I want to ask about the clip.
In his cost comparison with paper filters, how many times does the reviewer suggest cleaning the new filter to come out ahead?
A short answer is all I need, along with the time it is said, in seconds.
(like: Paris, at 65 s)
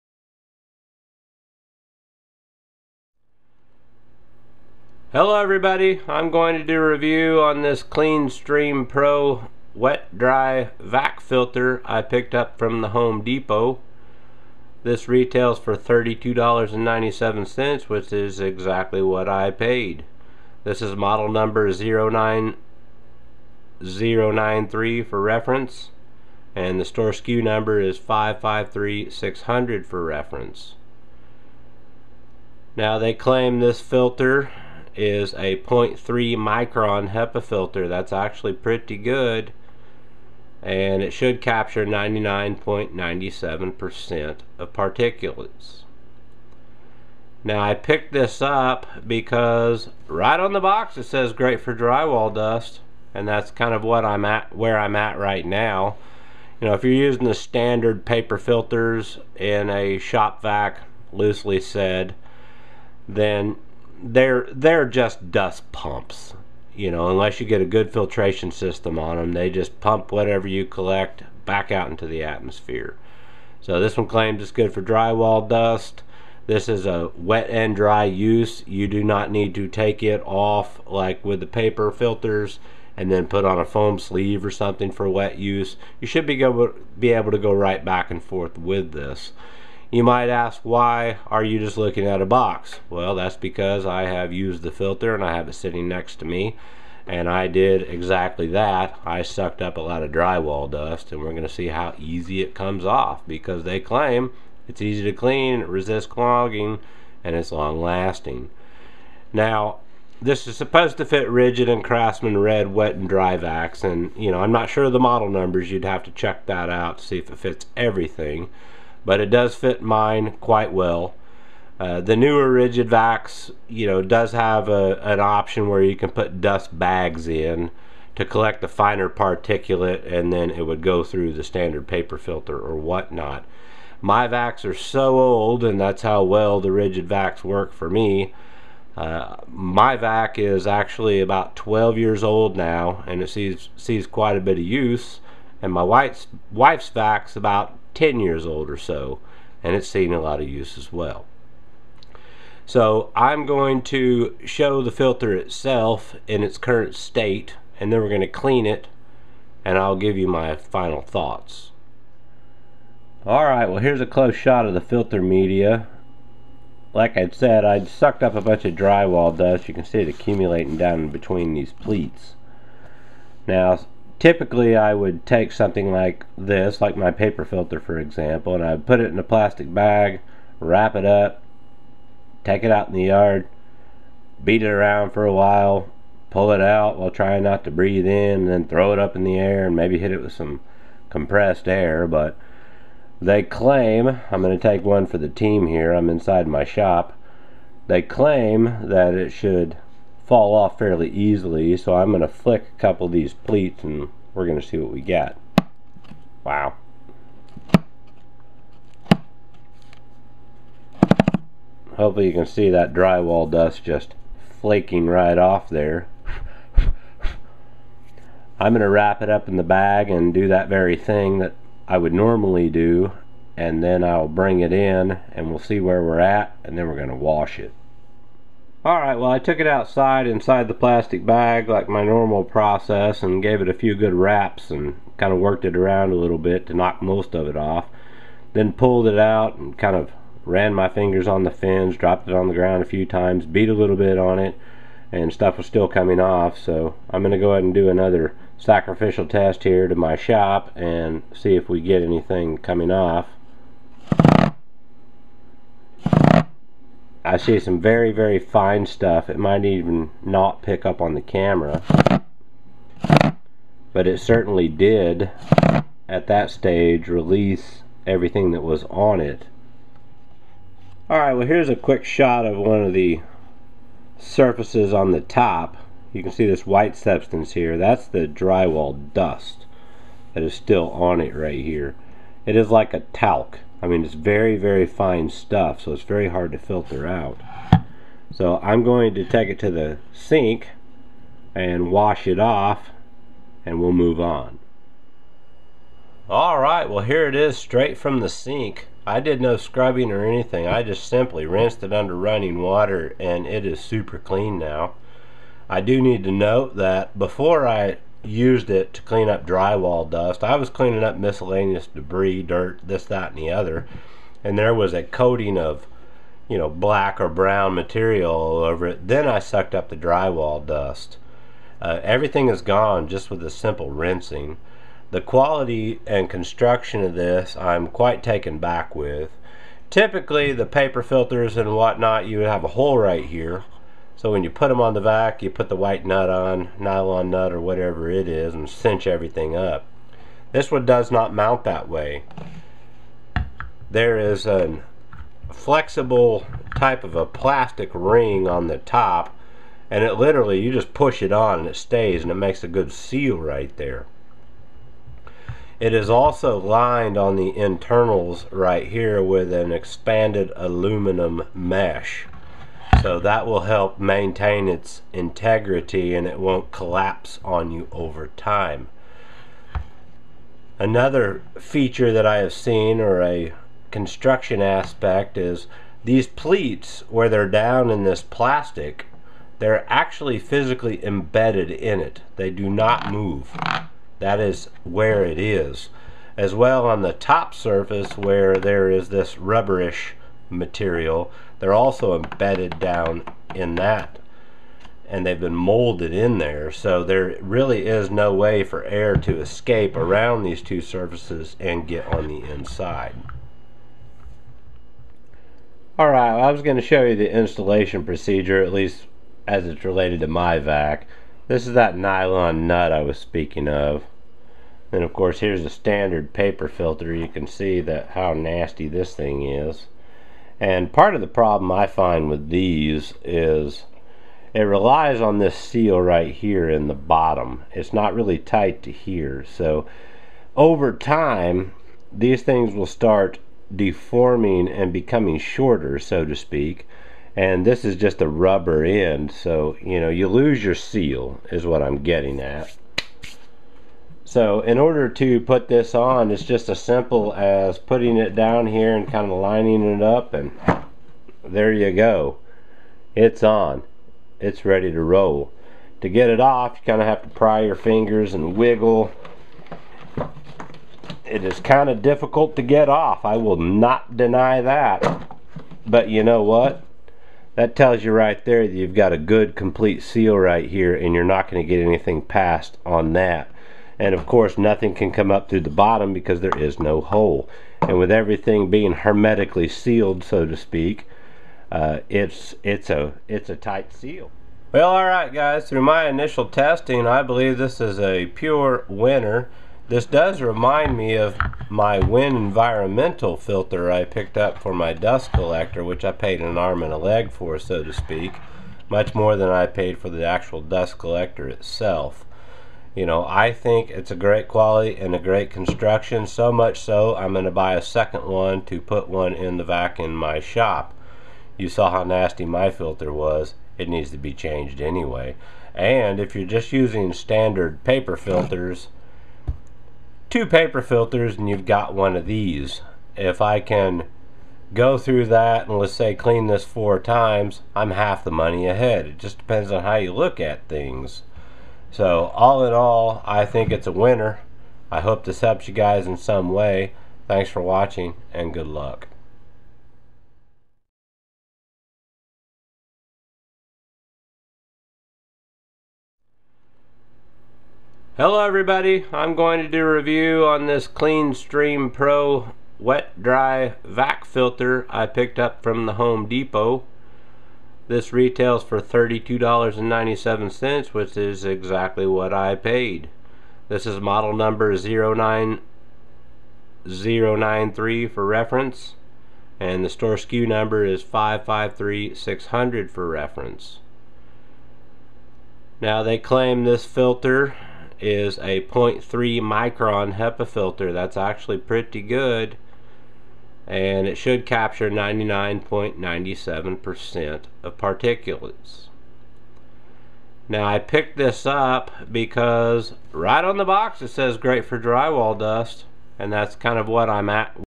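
4 times, at 526 s.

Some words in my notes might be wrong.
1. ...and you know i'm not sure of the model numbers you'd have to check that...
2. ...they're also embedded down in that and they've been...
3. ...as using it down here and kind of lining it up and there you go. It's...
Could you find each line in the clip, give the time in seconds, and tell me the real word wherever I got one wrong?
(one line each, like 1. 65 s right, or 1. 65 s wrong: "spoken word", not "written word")
1. 113 s right
2. 391 s right
3. 447 s wrong: "putting", not "using".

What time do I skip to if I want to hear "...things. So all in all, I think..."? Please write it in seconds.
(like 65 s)
530 s.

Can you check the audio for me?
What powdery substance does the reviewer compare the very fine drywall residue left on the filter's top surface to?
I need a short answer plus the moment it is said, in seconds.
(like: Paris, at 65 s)
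Talc, at 283 s.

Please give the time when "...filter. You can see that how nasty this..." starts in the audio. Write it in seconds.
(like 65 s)
416 s.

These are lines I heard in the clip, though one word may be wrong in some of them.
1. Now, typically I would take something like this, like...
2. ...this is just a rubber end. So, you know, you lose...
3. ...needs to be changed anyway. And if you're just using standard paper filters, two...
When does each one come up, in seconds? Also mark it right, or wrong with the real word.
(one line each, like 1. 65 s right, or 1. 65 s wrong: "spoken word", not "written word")
1. 173 s right
2. 437 s right
3. 513 s right.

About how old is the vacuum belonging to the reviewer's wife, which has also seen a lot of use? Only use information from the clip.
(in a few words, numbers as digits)
10 years.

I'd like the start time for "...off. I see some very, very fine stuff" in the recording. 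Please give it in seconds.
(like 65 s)
252 s.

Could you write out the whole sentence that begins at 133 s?
My vacs are so old and that's how well the Ridgid vacs work for me.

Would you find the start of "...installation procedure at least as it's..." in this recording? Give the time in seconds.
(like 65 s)
407 s.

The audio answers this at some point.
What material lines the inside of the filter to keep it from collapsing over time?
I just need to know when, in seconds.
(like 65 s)
359 s.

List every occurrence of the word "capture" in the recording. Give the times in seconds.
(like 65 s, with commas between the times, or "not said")
41 s, 584 s.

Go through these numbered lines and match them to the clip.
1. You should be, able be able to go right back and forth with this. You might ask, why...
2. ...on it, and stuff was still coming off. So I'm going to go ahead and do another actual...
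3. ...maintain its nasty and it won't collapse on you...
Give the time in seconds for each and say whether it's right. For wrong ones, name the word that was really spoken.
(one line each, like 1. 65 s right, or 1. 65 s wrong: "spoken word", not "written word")
1. 85 s right
2. 244 s wrong: "sacrificial", not "actual"
3. 363 s wrong: "integrity", not "nasty".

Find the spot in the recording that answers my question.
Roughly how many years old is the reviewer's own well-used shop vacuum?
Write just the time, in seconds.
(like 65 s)
141 s.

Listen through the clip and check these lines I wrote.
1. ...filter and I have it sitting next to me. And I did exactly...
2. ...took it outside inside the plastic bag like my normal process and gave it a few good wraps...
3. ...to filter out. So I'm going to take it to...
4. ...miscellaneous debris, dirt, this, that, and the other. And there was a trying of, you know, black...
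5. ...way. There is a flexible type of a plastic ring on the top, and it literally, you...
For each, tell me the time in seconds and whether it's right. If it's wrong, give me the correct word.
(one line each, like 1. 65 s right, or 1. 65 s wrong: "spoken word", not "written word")
1. 94 s right
2. 229 s right
3. 286 s right
4. 311 s wrong: "coating", not "trying"
5. 341 s right.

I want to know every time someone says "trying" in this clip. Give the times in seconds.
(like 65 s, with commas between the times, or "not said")
187 s.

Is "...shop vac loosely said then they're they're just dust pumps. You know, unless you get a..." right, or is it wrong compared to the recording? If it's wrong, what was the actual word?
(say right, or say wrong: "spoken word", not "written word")
right.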